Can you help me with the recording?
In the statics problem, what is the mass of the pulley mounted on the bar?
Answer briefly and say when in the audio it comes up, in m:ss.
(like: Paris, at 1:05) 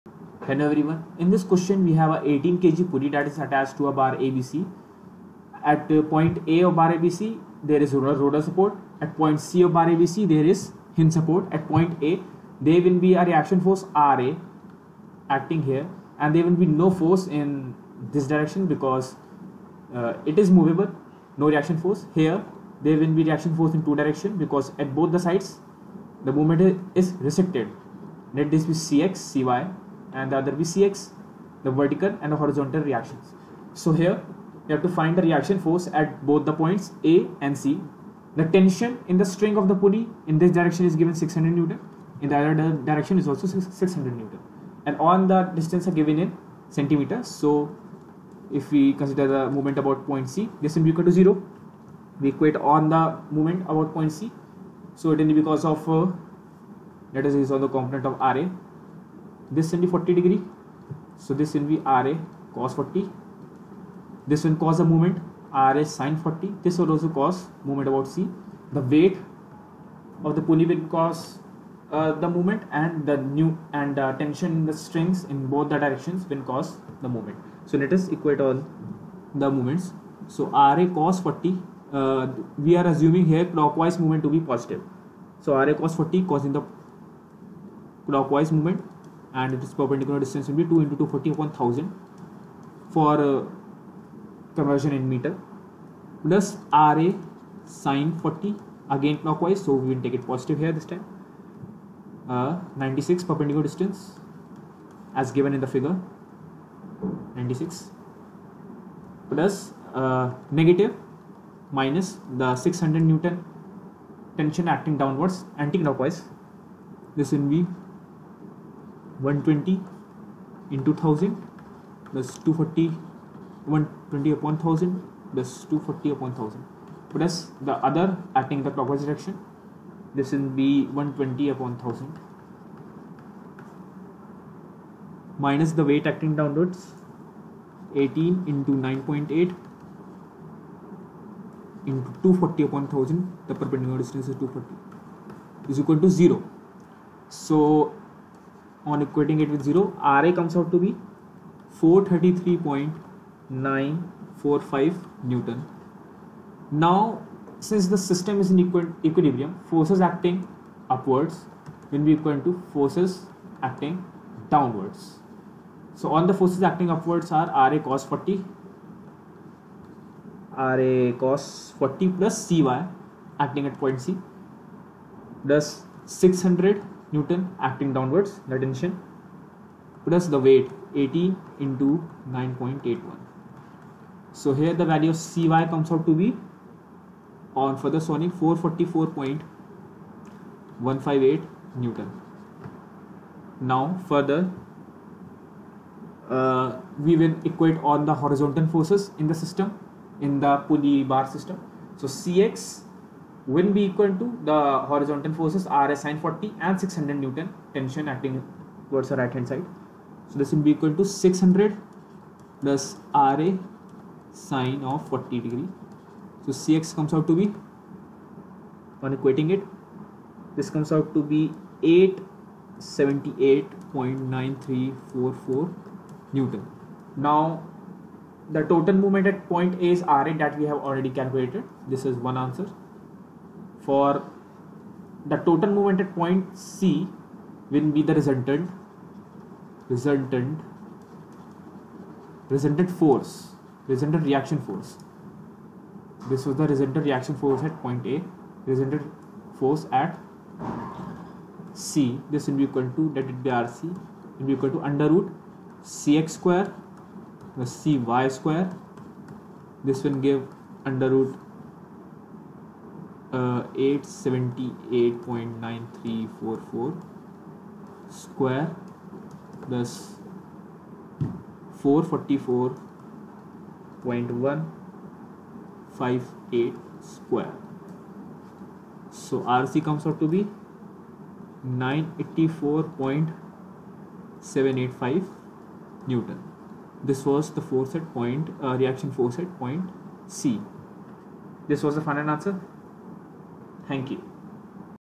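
18 kg, at 0:02.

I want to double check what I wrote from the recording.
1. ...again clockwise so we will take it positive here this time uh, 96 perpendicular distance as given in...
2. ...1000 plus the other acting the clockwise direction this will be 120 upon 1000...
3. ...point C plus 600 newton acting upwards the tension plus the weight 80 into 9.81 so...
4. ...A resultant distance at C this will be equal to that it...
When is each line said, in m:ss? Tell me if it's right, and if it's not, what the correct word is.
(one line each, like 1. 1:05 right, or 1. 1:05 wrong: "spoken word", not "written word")
1. 1:38 right
2. 2:06 right
3. 2:53 wrong: "downwards", not "upwards"
4. 4:08 wrong: "force", not "distance".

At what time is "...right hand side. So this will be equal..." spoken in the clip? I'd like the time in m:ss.
3:29.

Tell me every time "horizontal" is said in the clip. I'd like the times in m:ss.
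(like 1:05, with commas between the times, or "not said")
0:32, 3:18, 3:24.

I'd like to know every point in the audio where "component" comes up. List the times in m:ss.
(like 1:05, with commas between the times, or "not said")
0:57.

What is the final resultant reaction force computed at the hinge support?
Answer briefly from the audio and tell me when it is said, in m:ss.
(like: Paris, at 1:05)
984.785 N, at 4:41.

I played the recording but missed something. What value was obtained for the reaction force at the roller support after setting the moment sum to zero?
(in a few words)
433.945 N.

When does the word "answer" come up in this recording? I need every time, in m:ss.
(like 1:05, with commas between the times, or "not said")
3:52, 4:52.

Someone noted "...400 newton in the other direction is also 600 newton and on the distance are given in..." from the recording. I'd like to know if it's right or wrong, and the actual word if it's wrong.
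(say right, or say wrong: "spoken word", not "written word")
wrong: "600", not "400".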